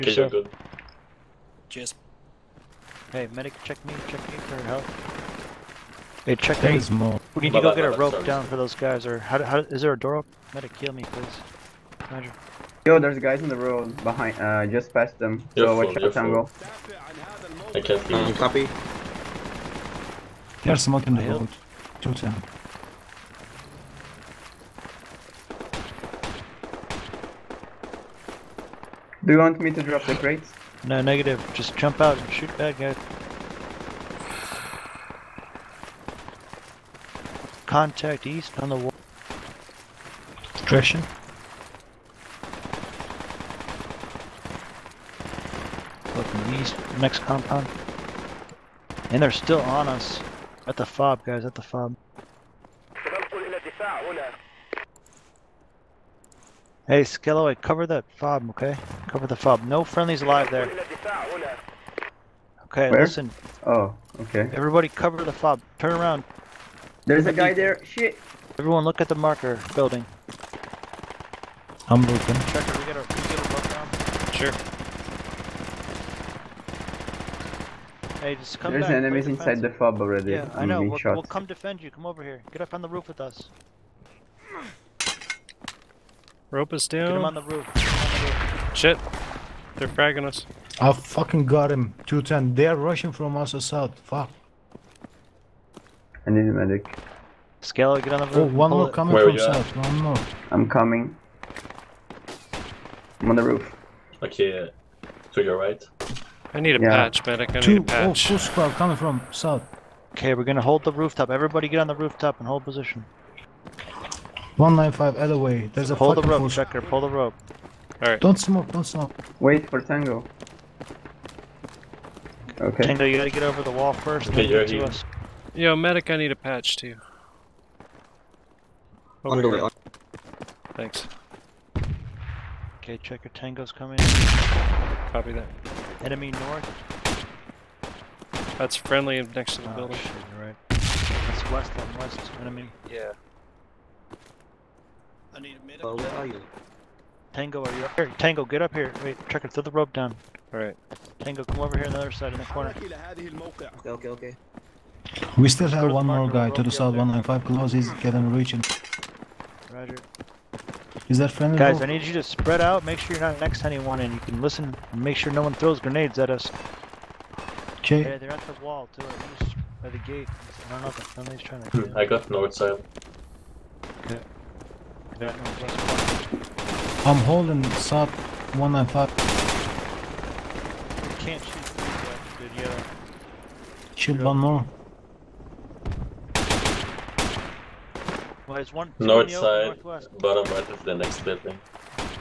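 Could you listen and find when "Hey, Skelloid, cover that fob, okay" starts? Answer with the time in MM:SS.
00:56.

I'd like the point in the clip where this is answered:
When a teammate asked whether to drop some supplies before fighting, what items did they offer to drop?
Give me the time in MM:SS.
00:30.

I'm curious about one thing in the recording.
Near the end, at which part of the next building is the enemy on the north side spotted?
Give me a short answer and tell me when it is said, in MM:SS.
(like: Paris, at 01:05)
bottom right, at 03:10.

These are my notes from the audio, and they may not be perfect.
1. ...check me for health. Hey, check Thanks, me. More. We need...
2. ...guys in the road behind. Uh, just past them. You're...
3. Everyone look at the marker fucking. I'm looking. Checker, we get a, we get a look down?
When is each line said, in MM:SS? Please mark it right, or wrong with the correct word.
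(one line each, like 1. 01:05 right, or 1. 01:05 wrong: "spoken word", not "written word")
1. 00:04 right
2. 00:13 right
3. 01:08 wrong: "building", not "fucking".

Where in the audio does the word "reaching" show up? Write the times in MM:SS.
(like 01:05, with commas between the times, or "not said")
02:38.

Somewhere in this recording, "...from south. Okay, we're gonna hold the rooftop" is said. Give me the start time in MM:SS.
01:48.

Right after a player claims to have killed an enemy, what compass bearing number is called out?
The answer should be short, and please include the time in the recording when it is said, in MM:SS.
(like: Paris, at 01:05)
210, at 01:32.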